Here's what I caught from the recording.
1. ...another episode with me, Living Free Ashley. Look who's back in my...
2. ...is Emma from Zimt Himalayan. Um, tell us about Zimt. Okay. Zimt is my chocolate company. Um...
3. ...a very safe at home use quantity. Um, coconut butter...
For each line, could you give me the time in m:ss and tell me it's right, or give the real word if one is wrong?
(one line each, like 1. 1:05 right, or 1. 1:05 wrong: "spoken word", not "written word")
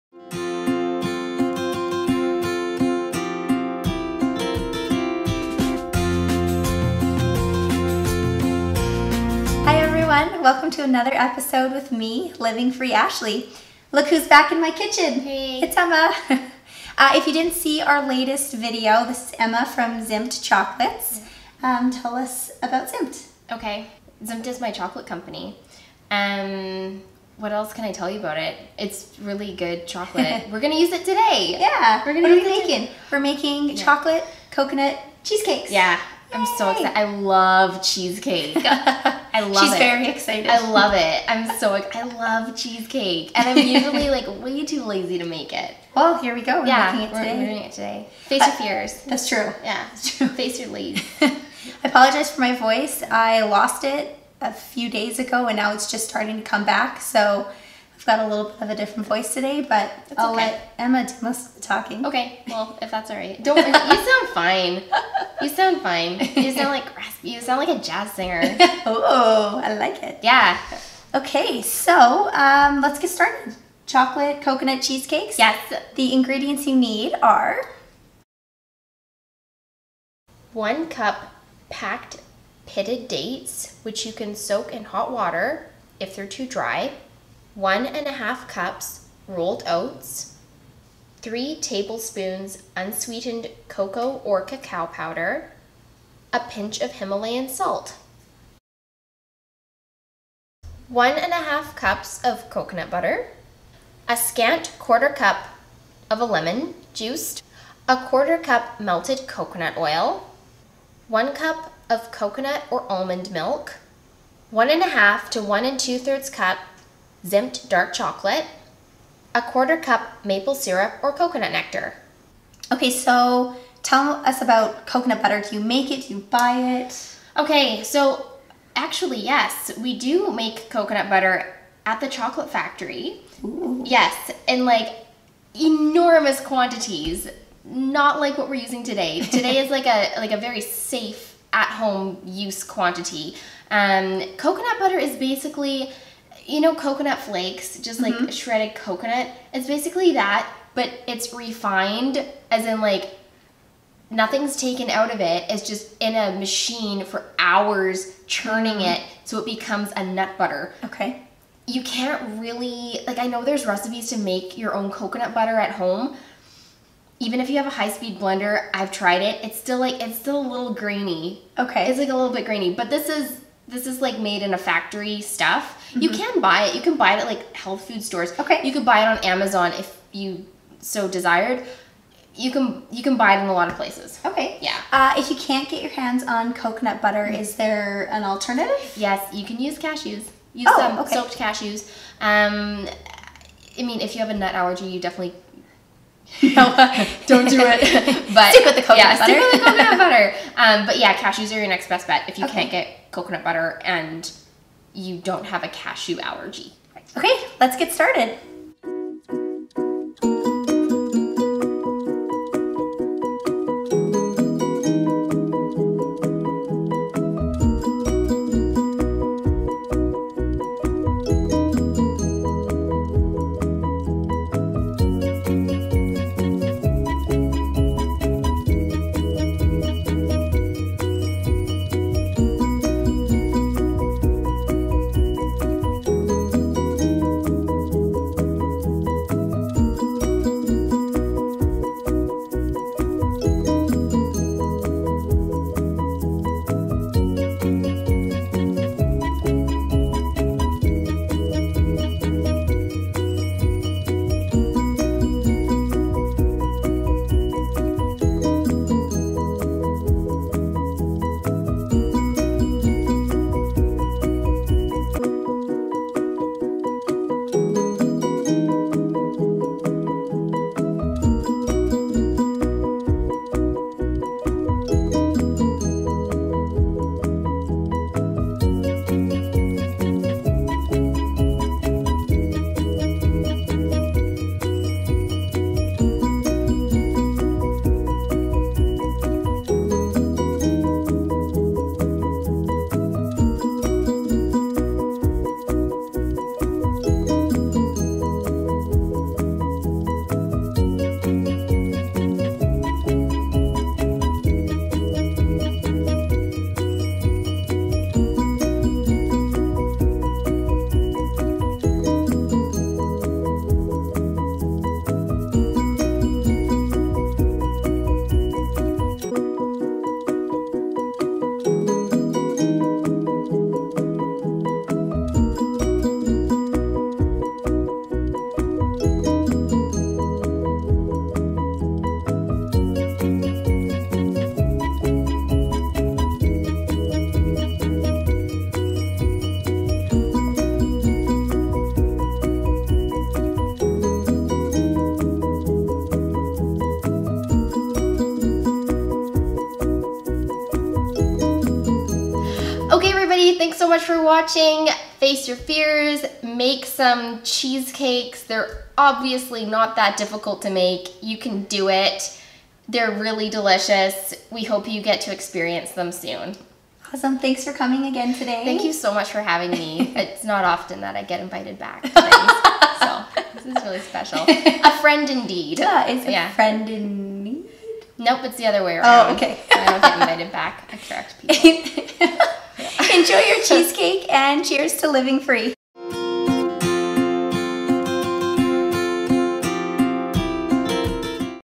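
1. 0:10 right
2. 0:19 wrong: "Chocolates", not "Himalayan"
3. 2:20 right.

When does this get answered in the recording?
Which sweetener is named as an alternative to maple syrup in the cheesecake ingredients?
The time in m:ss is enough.
2:01.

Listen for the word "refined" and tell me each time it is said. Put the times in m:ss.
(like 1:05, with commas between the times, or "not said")
2:31.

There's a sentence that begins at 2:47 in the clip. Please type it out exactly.
Even if you have a high-speed blender, I've tried it.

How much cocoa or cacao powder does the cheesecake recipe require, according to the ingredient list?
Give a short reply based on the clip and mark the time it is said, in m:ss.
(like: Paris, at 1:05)
3 tablespoons, at 1:31.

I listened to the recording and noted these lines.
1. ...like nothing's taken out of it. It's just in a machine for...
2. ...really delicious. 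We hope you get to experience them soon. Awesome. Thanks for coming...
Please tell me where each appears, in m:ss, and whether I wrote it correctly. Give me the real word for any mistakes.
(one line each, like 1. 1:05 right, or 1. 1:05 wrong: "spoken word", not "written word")
1. 2:32 right
2. 6:03 right.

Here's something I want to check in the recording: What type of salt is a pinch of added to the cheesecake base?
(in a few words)
Himalayan salt.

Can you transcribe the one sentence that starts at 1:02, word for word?
Okay, well, if that's all right.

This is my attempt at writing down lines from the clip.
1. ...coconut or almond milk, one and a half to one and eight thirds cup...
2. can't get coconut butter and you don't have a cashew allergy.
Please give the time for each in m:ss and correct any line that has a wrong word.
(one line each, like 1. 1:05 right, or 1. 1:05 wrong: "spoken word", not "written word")
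1. 1:52 wrong: "two", not "eight"
2. 3:22 right.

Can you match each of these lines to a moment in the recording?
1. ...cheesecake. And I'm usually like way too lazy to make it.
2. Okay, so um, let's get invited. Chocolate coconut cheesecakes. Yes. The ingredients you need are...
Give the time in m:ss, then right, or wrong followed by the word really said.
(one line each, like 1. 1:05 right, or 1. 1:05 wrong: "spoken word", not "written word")
1. 0:42 right
2. 1:11 wrong: "started", not "invited".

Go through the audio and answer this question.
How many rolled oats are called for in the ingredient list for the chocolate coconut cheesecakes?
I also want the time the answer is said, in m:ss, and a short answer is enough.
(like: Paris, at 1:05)
1.5 cups, at 1:27.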